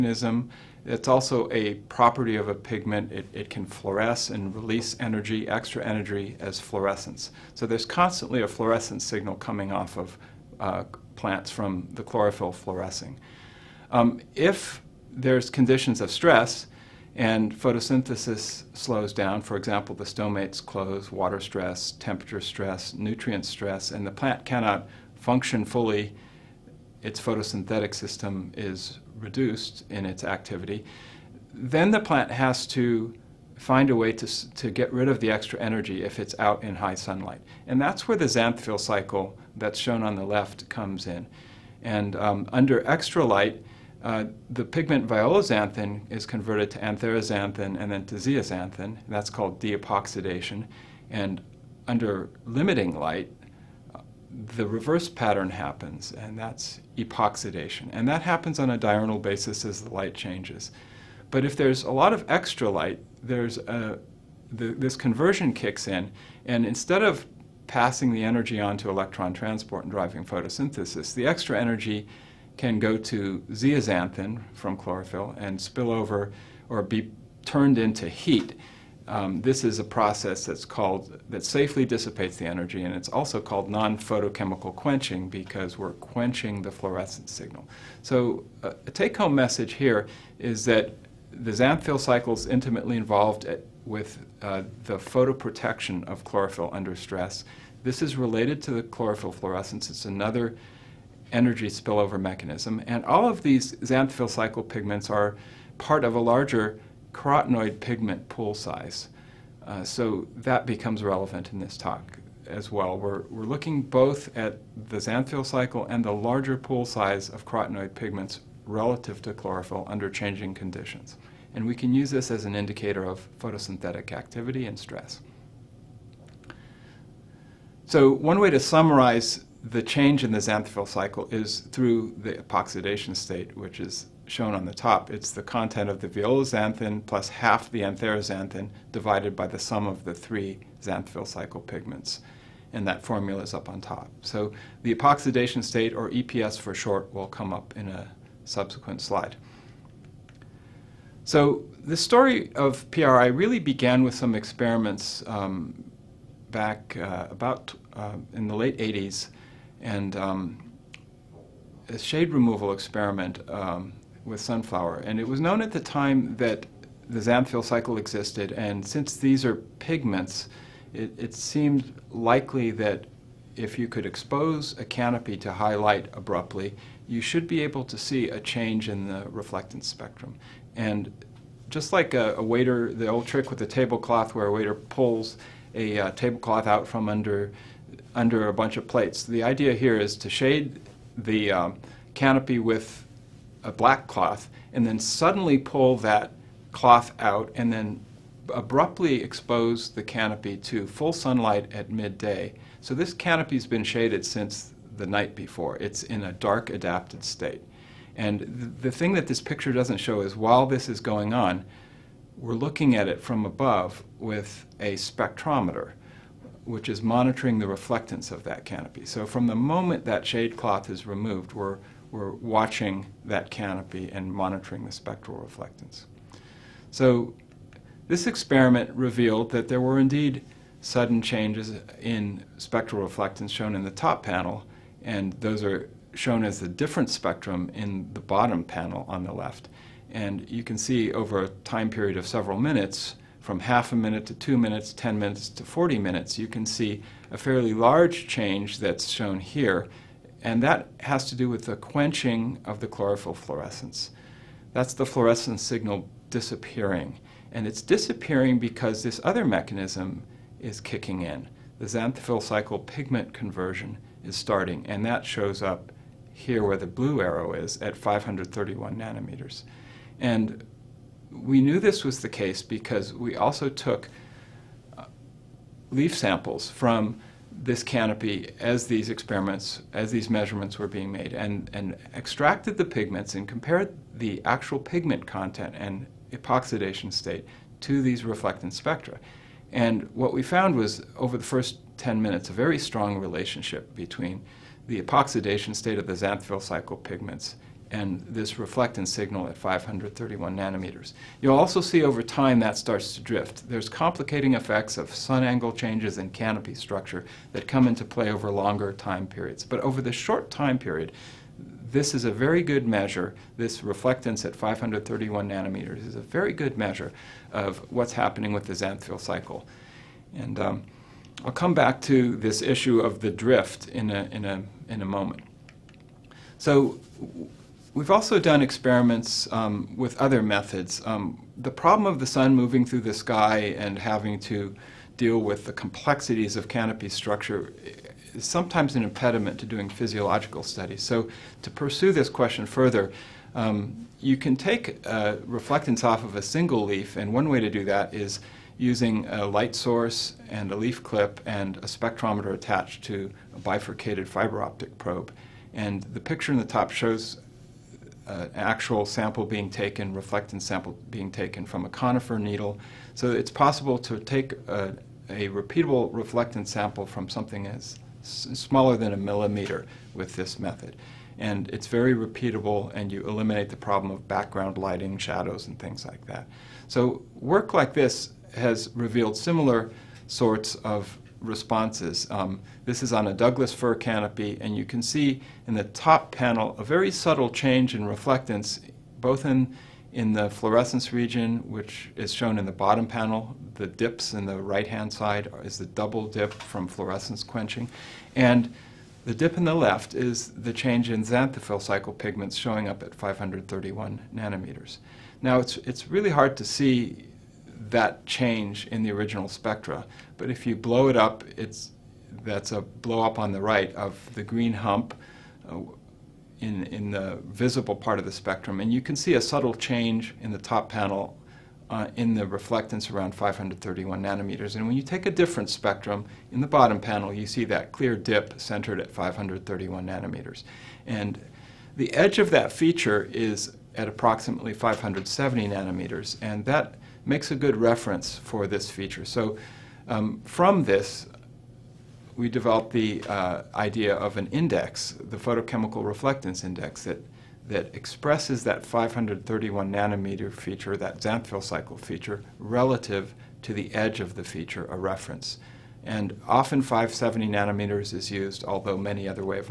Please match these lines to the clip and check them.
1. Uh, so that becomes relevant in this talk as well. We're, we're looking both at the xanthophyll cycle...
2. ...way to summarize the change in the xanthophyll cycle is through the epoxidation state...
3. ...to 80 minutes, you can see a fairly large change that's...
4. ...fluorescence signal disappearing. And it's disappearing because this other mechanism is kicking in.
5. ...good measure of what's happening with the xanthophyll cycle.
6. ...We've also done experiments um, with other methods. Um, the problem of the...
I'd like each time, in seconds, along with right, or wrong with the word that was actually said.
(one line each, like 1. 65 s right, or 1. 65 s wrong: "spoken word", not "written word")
1. 109 s right
2. 128 s right
3. 245 s wrong: "40", not "80"
4. 255 s right
5. 316 s right
6. 327 s right.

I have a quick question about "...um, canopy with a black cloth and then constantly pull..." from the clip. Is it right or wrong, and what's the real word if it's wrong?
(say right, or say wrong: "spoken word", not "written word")
wrong: "suddenly", not "constantly".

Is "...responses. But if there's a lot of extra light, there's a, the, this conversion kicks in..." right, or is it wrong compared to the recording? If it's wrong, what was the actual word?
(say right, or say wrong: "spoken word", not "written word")
wrong: "changes", not "responses".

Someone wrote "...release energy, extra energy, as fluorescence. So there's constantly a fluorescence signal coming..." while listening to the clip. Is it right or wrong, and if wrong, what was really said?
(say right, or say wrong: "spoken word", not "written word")
right.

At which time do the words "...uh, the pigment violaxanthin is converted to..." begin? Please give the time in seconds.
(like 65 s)
44 s.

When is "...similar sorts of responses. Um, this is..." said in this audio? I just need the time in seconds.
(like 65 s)
379 s.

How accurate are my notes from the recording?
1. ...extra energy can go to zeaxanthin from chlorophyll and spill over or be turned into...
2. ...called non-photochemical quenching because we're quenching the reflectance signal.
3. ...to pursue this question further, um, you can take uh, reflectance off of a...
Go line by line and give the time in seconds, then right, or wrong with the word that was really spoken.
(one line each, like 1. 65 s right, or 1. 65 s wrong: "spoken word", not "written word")
1. 71 s right
2. 83 s wrong: "fluorescence", not "reflectance"
3. 341 s right.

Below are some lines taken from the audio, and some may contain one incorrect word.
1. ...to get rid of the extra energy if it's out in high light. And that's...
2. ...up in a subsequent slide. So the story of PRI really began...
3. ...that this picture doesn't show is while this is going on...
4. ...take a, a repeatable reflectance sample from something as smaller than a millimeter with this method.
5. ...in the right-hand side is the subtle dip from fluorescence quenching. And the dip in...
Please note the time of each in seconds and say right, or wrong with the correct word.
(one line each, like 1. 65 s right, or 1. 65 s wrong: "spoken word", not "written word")
1. 34 s wrong: "sunlight", not "light"
2. 147 s right
3. 209 s right
4. 364 s right
5. 394 s wrong: "double", not "subtle".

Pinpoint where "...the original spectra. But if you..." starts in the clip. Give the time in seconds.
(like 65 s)
409 s.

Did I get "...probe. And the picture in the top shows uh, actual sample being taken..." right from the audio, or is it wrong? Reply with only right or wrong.
right.